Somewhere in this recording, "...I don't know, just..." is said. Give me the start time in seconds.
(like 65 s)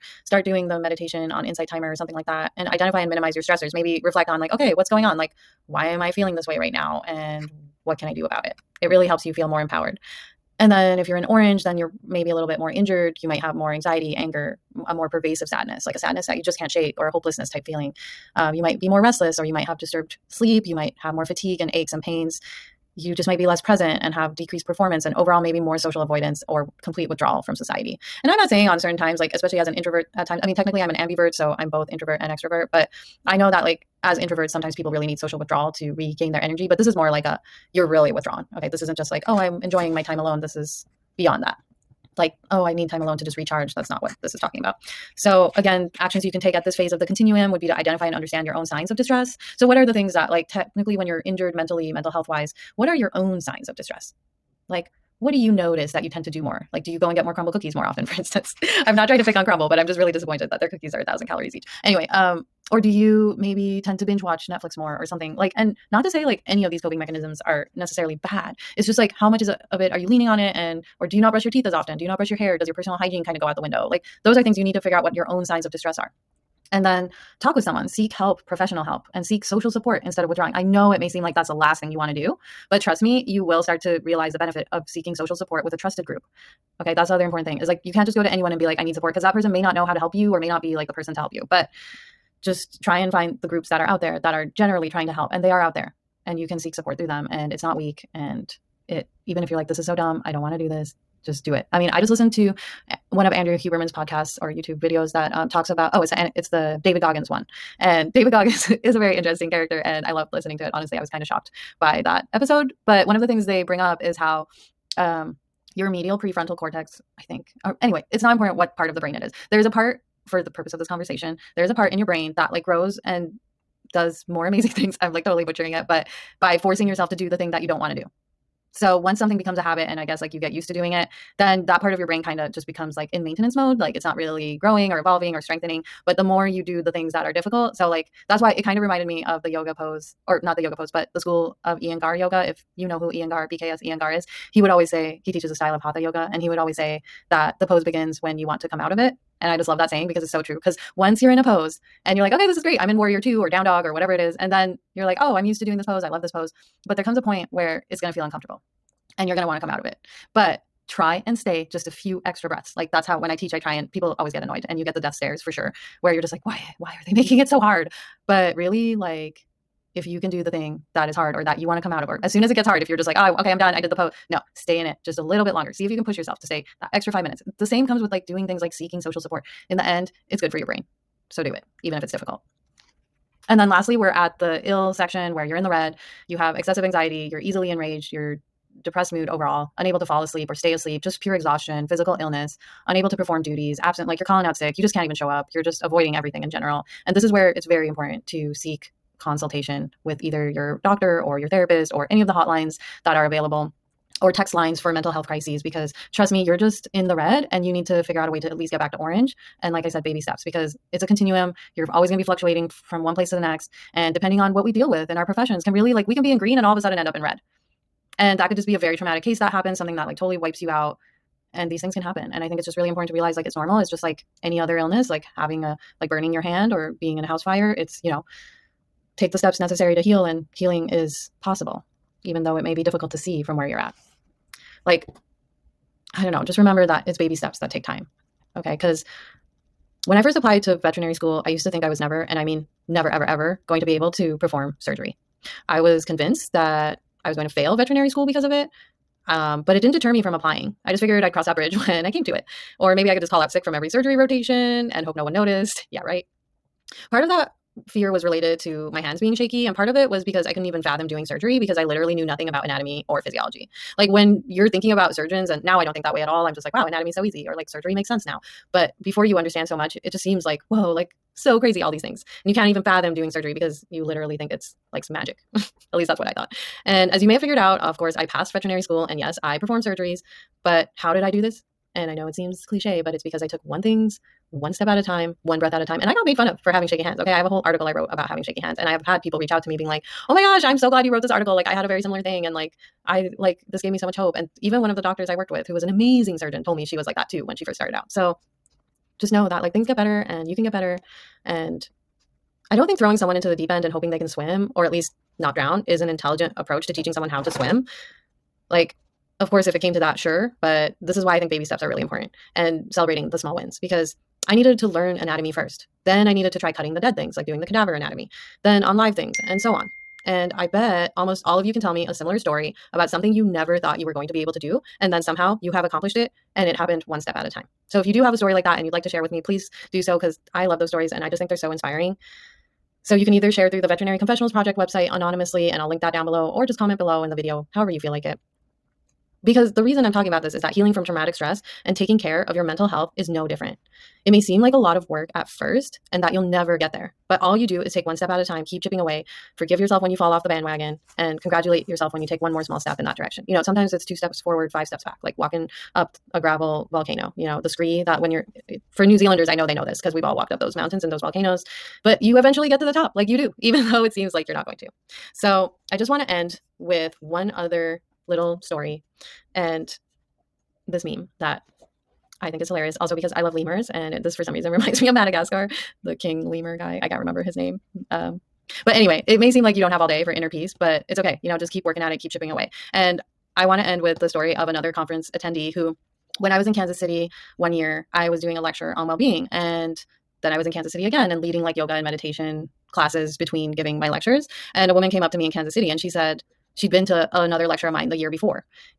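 236 s.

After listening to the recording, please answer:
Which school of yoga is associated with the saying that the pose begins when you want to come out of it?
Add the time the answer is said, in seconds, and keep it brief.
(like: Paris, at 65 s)
Iyengar yoga, at 141 s.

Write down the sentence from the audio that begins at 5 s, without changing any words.
Like, why am I feeling this way right now?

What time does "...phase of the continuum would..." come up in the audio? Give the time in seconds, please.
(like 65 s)
46 s.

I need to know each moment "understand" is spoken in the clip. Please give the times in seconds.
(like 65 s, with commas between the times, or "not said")
48 s, 269 s.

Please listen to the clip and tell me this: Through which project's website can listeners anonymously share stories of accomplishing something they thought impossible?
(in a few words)
Veterinary Confessionals Project.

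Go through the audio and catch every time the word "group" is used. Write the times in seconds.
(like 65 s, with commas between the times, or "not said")
86 s, 93 s.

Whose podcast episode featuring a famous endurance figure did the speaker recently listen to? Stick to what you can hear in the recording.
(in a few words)
Andrew Huberman.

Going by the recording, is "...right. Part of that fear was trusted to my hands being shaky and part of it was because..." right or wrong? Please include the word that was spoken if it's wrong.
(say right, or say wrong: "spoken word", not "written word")
wrong: "related", not "trusted".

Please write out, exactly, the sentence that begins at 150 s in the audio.
Because once you're in a pose and you're like, okay, this is great.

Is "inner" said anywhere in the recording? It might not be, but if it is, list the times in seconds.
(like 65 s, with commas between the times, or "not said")
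380 s.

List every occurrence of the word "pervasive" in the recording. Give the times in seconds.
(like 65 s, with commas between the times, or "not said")
15 s.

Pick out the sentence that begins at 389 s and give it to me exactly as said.
And then I was in Kansas City again and leading like yoga and meditation classes between giving my lectures.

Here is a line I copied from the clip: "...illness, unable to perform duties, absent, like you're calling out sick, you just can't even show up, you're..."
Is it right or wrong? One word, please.
right.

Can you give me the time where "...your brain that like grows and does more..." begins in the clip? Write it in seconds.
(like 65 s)
121 s.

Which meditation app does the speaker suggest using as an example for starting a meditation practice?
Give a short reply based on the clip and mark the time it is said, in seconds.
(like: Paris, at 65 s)
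Insight Timer, at 1 s.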